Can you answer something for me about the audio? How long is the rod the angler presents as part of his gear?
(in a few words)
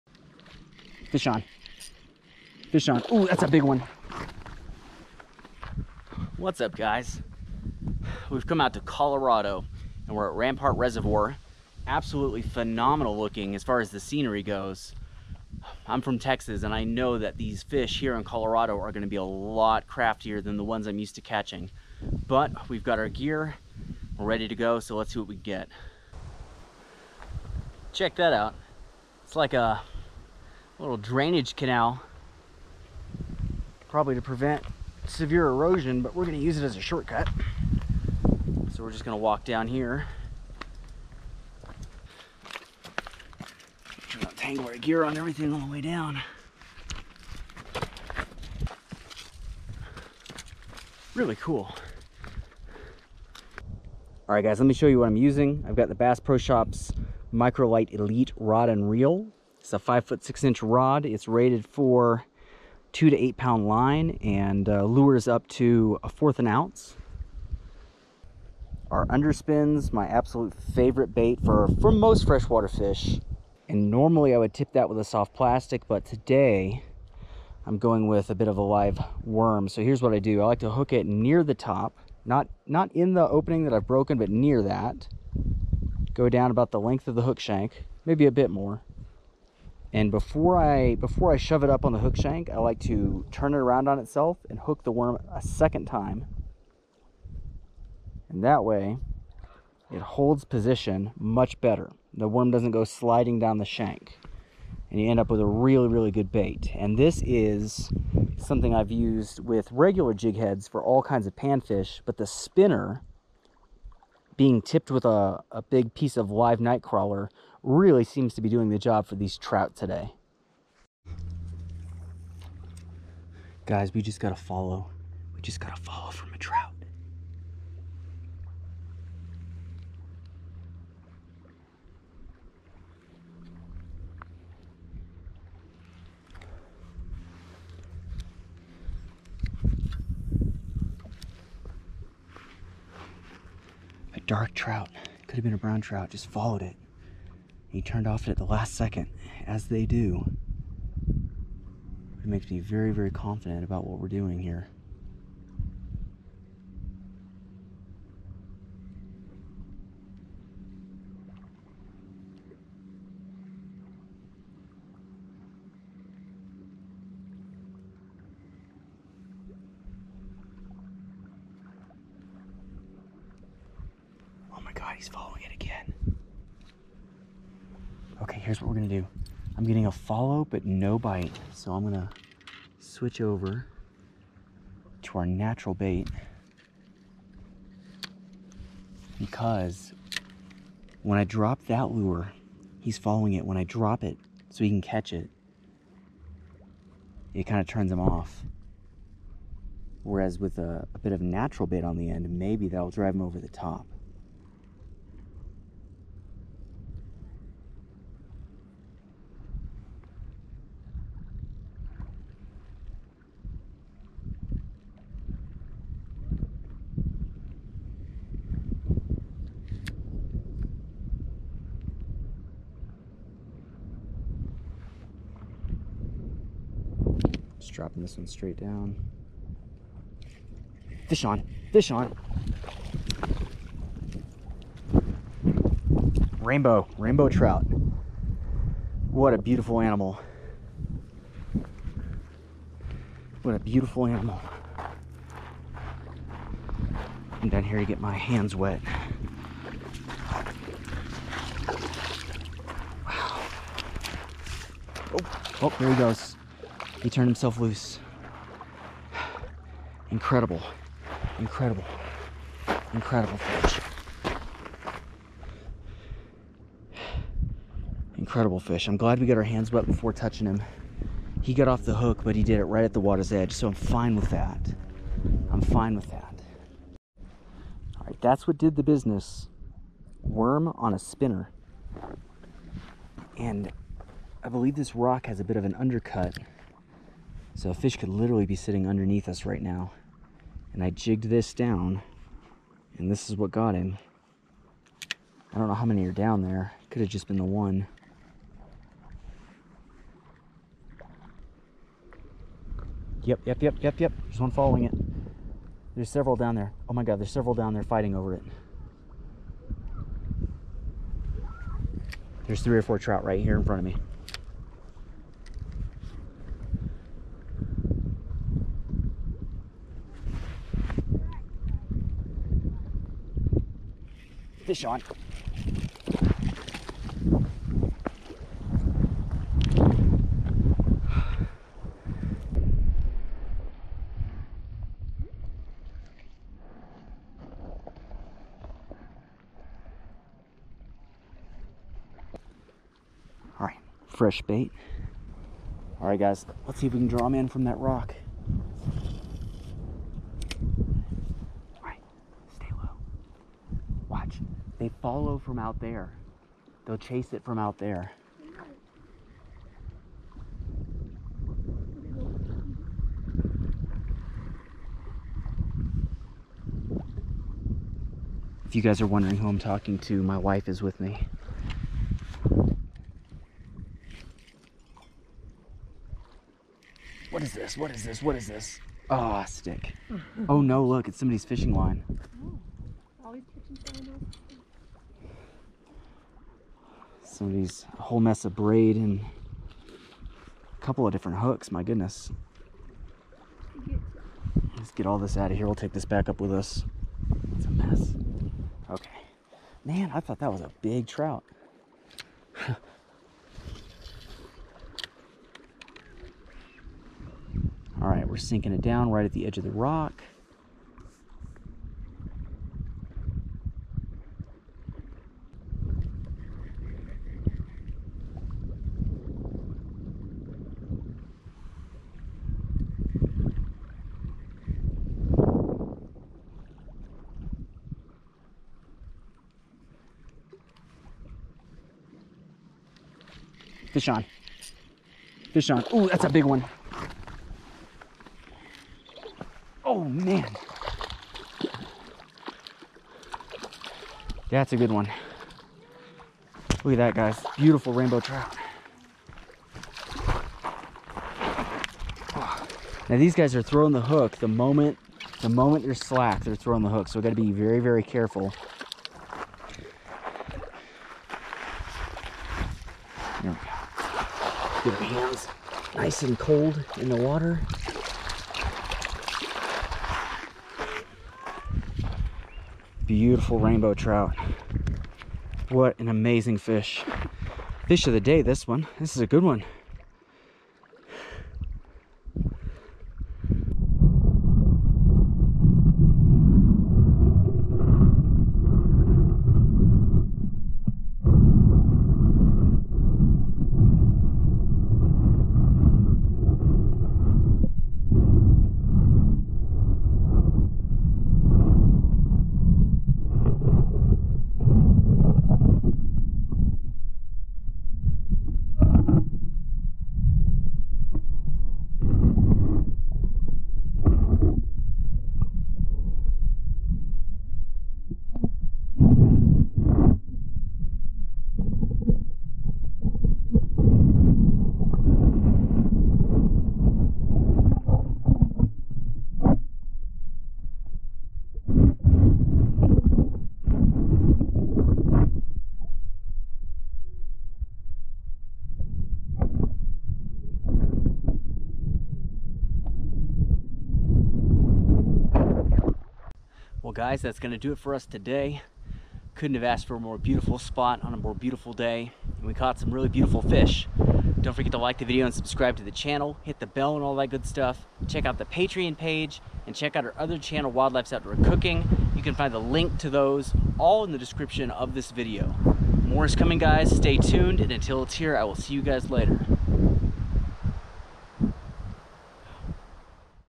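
5 feet 6 inches.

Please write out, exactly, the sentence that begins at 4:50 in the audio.
And I jigged this down, and this is what got him.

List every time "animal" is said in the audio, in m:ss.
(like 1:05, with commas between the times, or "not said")
3:59, 4:04.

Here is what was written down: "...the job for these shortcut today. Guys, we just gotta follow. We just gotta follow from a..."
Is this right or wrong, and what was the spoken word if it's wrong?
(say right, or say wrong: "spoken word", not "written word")
wrong: "trout", not "shortcut".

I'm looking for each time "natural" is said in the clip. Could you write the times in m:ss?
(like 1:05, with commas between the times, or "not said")
3:05, 3:21.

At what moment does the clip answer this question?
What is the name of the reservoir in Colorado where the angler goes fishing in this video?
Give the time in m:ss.
0:10.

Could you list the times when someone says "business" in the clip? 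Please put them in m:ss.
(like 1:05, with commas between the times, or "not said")
4:38.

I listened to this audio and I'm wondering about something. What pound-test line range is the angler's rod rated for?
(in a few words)
2 to 8 pound.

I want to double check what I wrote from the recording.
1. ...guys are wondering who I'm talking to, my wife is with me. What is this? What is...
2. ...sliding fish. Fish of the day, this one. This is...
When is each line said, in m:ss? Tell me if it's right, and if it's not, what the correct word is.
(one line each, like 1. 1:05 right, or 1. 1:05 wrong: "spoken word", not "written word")
1. 6:08 right
2. 7:56 wrong: "amazing", not "sliding".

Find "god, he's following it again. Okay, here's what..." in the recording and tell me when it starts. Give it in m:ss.
2:54.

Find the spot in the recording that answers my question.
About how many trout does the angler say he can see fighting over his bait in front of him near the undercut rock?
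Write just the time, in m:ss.
5:12.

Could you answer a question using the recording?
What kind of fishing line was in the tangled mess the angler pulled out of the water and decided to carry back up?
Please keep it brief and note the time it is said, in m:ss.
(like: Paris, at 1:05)
Braid, at 6:28.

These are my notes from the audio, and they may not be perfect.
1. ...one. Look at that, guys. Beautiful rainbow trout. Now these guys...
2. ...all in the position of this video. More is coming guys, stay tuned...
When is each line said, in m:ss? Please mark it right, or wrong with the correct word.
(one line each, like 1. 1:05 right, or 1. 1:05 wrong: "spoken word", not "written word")
1. 7:24 right
2. 9:23 wrong: "description", not "position".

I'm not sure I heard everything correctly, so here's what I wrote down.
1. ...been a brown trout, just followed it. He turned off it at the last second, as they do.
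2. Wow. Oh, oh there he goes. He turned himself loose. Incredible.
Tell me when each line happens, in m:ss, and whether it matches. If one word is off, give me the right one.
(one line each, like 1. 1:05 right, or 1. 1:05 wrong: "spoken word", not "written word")
1. 2:25 right
2. 4:13 right.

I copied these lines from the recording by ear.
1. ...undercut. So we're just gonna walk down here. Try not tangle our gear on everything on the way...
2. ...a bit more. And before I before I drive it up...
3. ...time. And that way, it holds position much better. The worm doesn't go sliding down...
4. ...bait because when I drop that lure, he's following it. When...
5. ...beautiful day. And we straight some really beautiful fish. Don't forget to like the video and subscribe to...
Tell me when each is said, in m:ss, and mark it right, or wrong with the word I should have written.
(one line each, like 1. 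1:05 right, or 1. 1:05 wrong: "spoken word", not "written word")
1. 0:36 wrong: "shortcut", not "undercut"
2. 1:28 wrong: "shove", not "drive"
3. 1:35 right
4. 3:05 right
5. 9:11 wrong: "caught", not "straight".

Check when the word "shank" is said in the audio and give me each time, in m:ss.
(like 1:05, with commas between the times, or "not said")
1:27, 1:32, 1:43.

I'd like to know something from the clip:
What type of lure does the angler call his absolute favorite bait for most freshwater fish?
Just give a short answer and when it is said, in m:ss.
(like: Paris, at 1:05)
Underspins, at 1:09.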